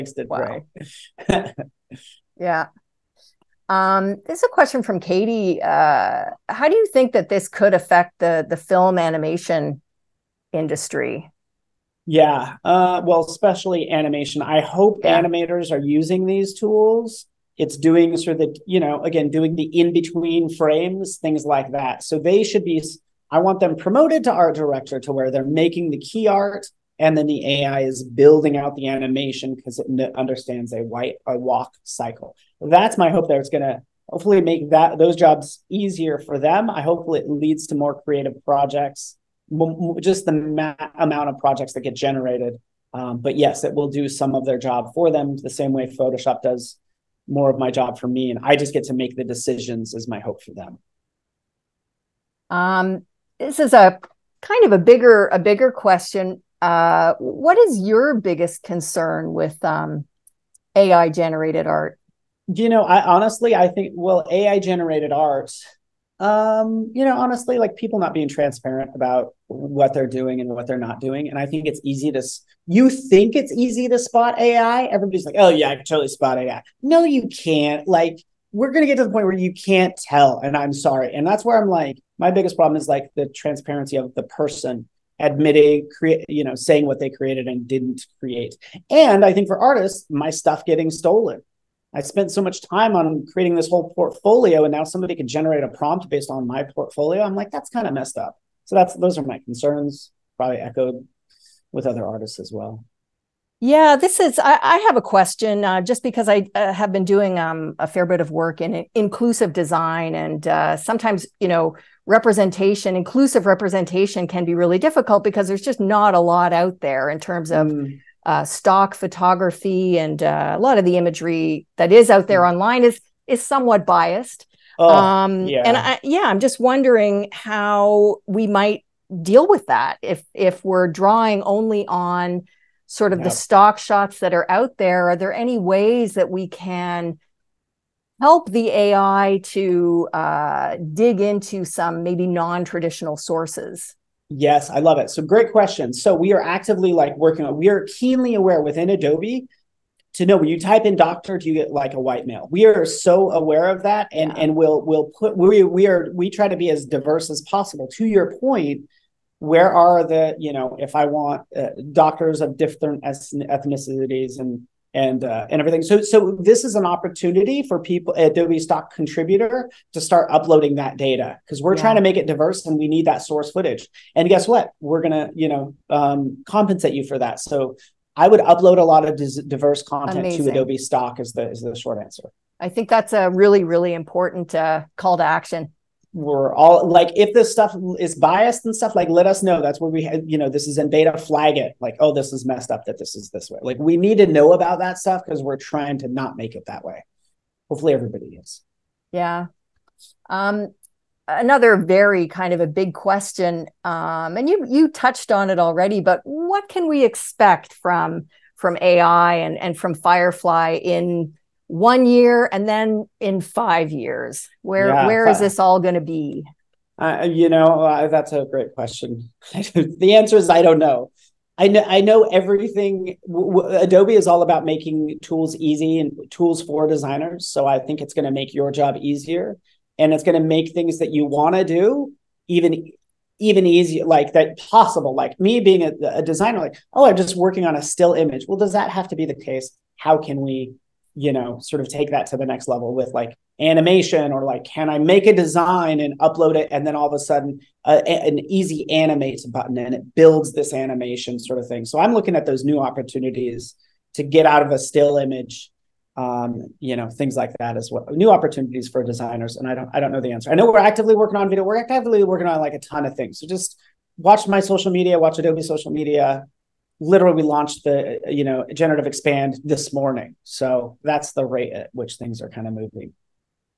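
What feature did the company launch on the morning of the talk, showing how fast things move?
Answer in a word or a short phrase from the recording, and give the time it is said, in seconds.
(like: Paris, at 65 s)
Generative expand, at 268 s.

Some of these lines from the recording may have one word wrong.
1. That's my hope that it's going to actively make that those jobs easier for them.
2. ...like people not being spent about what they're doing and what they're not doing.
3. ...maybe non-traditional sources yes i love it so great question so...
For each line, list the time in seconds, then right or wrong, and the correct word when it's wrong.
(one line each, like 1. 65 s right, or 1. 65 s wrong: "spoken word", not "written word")
1. 32 s wrong: "hopefully", not "actively"
2. 67 s wrong: "transparent", not "spent"
3. 142 s right.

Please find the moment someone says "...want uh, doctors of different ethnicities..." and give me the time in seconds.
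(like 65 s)
161 s.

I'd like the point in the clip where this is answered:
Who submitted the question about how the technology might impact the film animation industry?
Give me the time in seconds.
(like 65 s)
4 s.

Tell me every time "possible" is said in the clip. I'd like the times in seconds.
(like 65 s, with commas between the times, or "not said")
157 s, 234 s.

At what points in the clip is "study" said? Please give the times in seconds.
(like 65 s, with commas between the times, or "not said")
not said.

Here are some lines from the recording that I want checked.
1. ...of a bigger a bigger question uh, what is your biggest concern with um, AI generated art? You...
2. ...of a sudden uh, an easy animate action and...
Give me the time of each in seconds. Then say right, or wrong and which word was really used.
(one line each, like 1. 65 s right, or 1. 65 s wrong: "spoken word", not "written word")
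1. 54 s right
2. 247 s wrong: "button", not "action".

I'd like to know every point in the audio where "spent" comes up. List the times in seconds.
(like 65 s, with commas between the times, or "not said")
92 s.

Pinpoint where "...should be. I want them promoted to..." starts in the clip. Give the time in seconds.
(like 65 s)
22 s.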